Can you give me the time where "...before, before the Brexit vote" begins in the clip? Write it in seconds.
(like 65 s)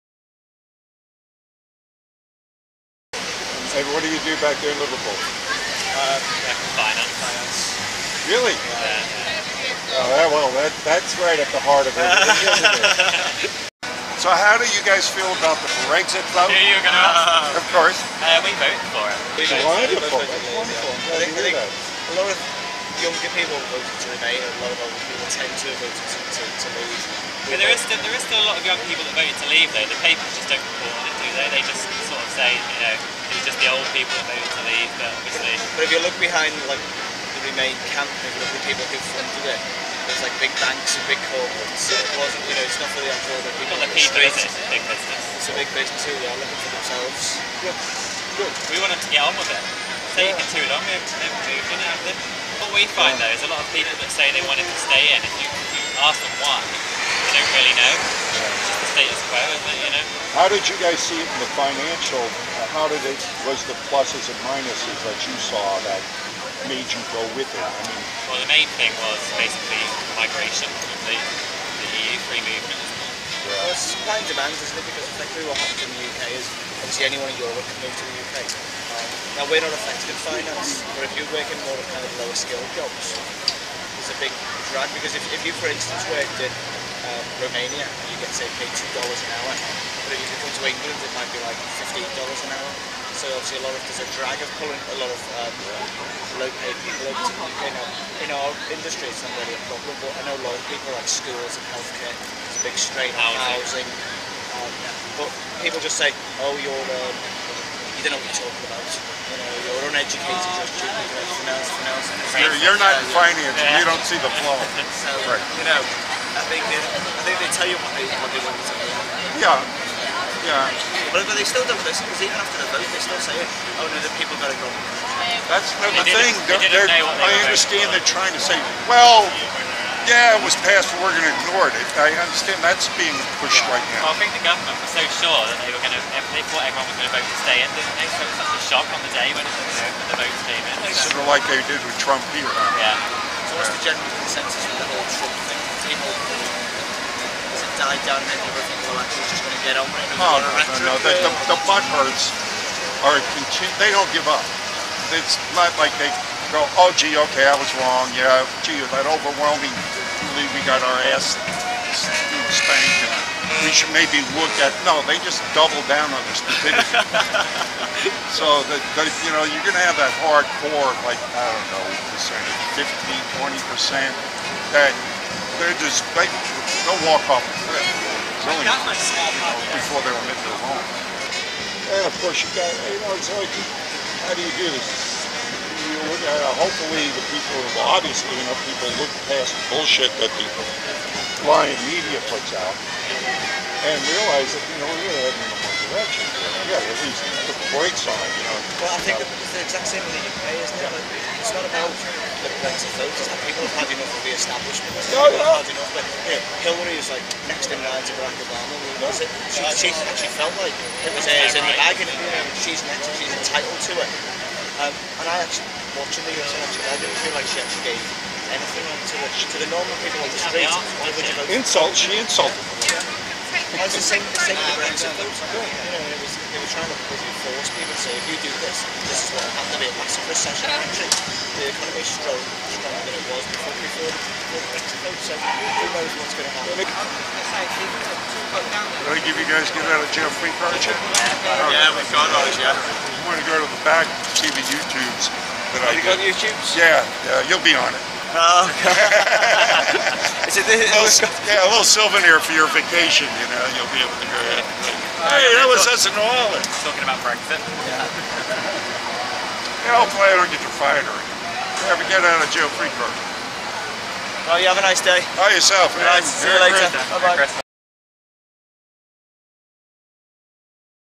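233 s.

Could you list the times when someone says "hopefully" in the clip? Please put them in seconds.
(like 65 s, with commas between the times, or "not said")
186 s, 260 s.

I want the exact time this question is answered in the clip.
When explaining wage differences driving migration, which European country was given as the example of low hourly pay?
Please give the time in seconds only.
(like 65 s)
87 s.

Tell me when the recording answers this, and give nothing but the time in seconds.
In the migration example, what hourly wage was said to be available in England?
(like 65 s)
91 s.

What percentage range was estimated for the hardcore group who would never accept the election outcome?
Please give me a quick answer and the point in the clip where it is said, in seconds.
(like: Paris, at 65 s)
15-20%, at 172 s.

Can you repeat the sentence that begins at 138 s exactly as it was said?
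So it was such a shock on the day when, you know, when the votes came in.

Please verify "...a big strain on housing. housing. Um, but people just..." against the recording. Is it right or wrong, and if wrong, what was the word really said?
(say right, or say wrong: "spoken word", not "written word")
right.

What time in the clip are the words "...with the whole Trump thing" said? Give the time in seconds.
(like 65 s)
144 s.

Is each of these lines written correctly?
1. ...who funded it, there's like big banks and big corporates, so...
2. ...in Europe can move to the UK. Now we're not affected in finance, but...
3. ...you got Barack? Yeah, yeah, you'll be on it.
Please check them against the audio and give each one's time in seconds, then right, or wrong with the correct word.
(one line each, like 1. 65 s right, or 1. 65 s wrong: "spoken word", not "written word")
1. 38 s right
2. 77 s right
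3. 245 s wrong: "YouTubes", not "Barack".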